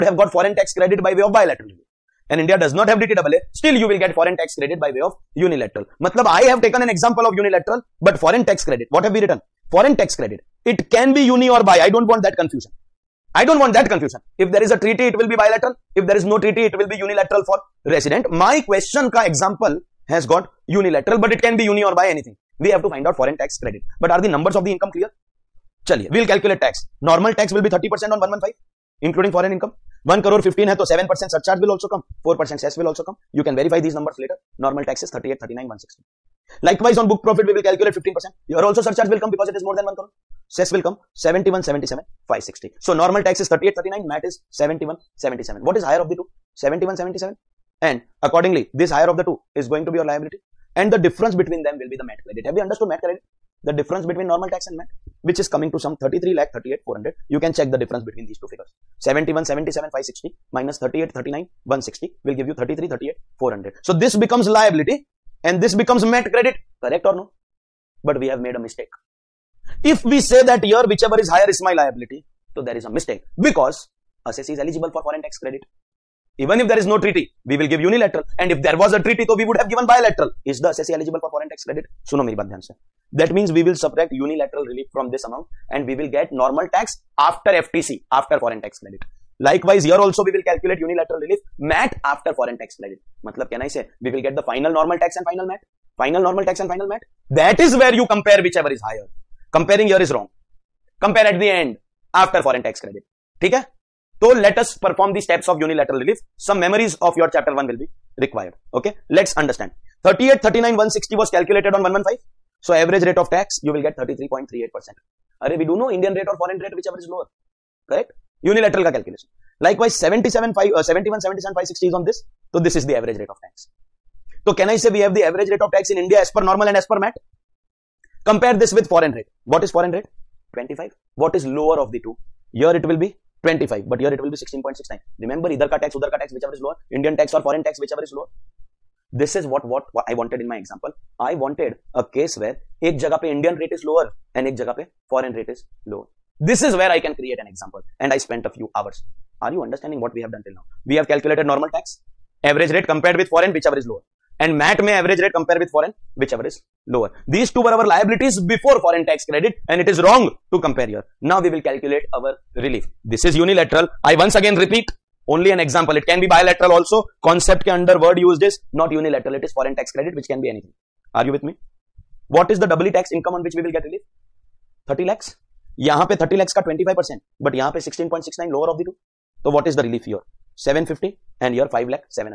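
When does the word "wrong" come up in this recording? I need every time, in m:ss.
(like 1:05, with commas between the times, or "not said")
1:40, 2:40.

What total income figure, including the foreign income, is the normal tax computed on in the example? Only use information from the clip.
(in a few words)
1 crore 15 lakh.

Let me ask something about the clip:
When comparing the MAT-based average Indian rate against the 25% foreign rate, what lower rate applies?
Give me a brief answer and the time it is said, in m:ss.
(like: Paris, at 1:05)
16.69%, at 2:14.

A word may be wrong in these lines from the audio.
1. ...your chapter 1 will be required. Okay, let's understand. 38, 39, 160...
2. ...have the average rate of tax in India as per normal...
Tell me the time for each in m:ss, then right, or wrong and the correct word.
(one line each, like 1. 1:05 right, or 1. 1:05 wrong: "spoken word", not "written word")
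1. 1:47 right
2. 2:04 right.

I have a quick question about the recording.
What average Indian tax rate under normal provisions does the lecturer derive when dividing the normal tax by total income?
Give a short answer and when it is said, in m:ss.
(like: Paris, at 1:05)
33.38%, at 1:53.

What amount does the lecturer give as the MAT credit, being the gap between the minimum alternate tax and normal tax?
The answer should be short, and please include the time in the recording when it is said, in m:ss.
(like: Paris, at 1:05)
33,38,400, at 0:55.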